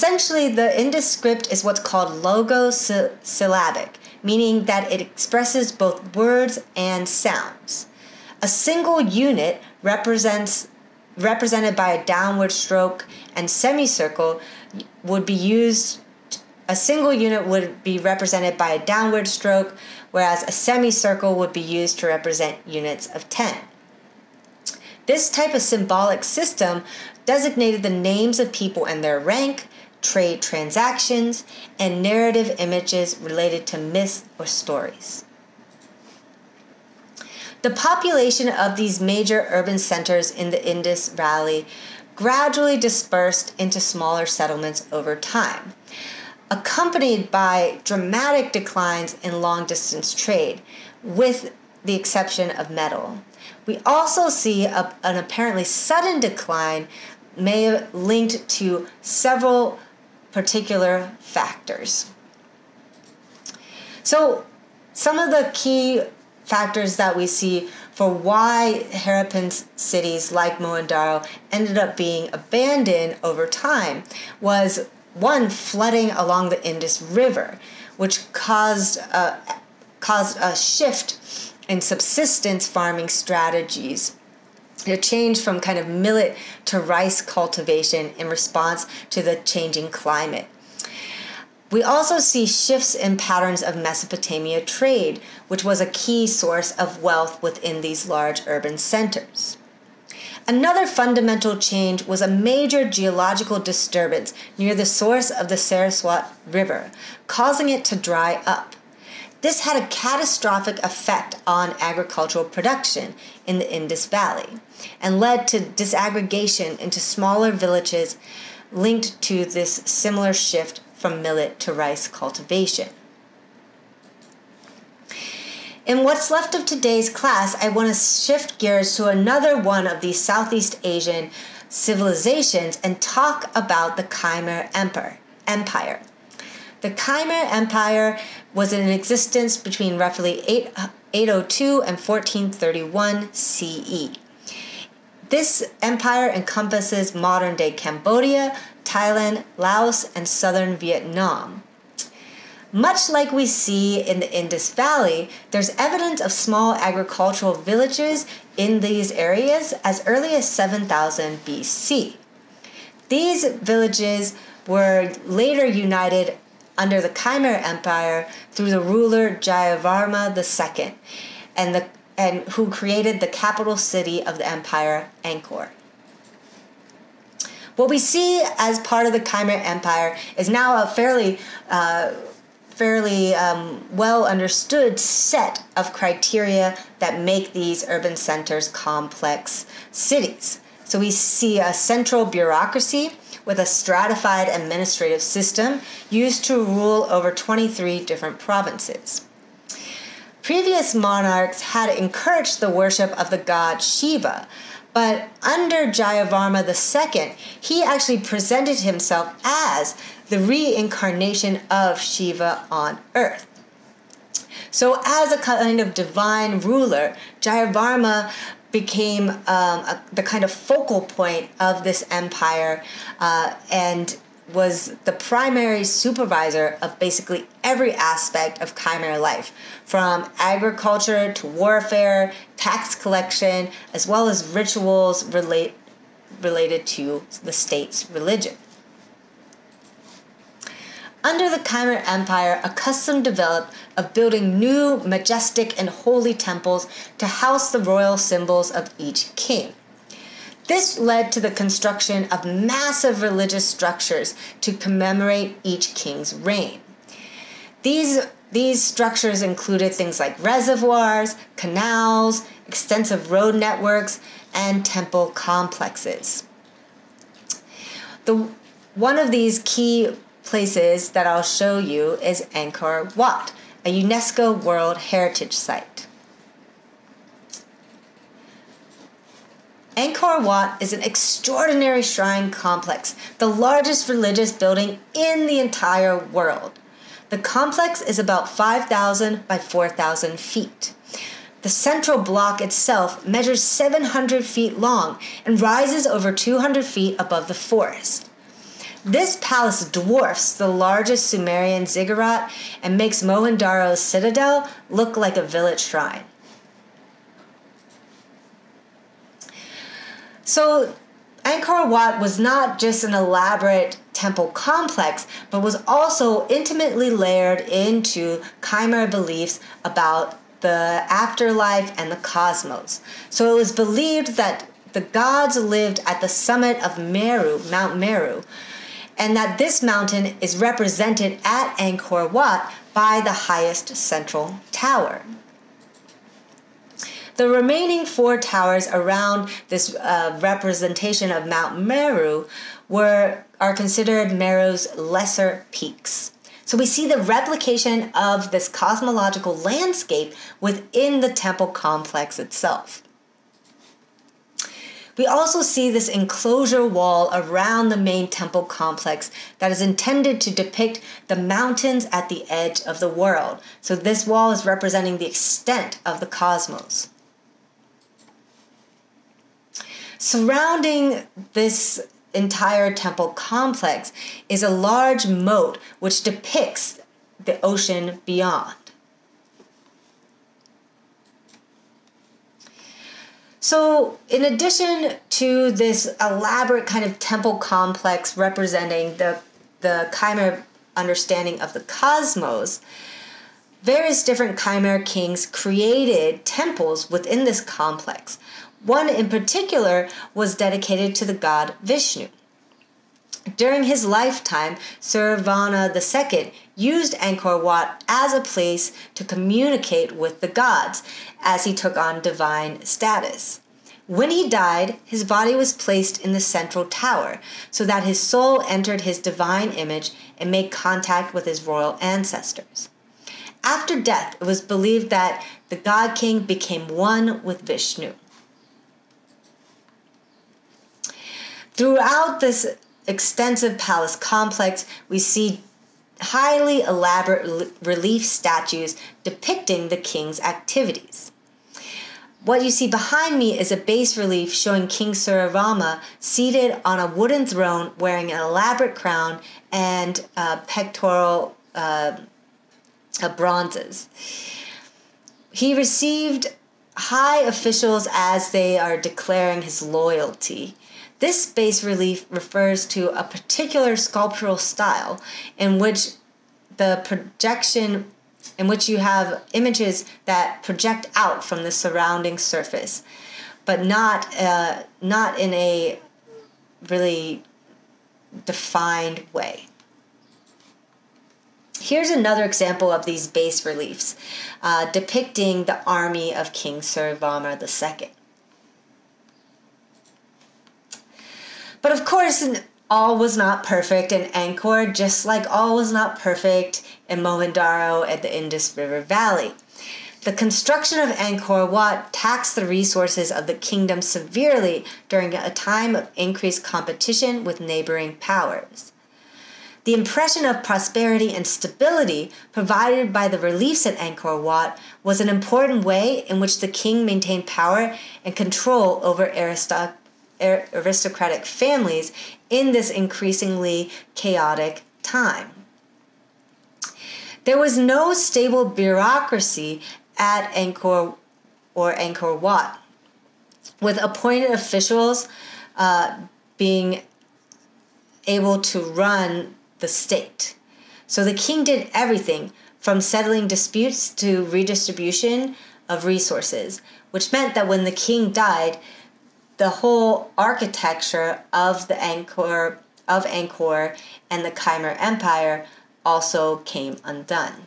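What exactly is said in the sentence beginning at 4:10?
This led to the construction of massive religious structures to commemorate each king's reign.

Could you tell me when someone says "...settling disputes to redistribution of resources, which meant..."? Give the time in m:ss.
9:02.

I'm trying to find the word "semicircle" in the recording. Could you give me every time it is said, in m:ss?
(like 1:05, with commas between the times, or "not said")
0:13, 0:20.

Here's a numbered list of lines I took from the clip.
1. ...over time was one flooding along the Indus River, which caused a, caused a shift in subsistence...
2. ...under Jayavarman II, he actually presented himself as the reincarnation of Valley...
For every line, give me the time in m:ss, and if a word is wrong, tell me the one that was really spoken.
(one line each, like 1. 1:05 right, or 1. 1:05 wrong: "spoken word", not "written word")
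1. 1:13 right
2. 3:25 wrong: "Shiva", not "Valley".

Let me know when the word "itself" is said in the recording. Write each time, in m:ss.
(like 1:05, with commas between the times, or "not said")
4:52, 5:52.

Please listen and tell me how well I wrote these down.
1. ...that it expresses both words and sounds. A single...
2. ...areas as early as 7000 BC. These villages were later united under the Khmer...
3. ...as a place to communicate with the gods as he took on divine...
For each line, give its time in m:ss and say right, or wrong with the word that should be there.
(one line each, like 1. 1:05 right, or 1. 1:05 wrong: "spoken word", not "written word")
1. 0:04 right
2. 2:39 right
3. 6:48 right.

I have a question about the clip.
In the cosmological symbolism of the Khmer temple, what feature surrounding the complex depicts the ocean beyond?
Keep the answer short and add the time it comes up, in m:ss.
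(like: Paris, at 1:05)
a large moat, at 6:14.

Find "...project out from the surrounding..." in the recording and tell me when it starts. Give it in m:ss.
7:50.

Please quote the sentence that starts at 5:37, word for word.
The remaining four towers around this uh, representation of Mount Meru were are considered Meru's lesser peaks.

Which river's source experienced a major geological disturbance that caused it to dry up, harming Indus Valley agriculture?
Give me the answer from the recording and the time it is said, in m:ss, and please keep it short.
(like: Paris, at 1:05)
Saraswati River, at 1:45.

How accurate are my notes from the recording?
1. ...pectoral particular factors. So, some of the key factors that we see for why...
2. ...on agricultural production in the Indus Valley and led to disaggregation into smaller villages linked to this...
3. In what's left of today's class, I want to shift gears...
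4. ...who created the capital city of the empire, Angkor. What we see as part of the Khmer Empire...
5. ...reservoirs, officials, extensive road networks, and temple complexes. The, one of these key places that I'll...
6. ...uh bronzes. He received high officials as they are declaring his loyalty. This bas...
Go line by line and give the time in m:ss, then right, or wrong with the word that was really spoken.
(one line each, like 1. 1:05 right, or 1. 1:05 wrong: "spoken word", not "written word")
1. 0:58 wrong: "several", not "pectoral"
2. 1:51 right
3. 2:05 right
4. 2:52 right
5. 4:20 wrong: "canals", not "officials"
6. 7:33 right.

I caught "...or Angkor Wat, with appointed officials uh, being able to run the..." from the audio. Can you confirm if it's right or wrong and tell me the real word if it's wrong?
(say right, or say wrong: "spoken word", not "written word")
right.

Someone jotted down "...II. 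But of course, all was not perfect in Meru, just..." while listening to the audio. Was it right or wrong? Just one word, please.
wrong.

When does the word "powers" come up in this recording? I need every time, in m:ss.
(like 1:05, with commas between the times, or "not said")
8:28, 8:37.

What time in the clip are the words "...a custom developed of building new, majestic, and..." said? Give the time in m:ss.
4:02.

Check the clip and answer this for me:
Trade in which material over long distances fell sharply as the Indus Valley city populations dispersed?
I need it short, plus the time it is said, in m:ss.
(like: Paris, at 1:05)
metal, at 0:52.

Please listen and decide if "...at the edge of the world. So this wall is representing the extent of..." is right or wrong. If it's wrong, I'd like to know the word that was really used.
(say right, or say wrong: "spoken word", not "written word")
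right.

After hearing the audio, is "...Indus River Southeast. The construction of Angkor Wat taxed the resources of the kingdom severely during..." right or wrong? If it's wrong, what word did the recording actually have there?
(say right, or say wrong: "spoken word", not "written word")
wrong: "Valley", not "Southeast".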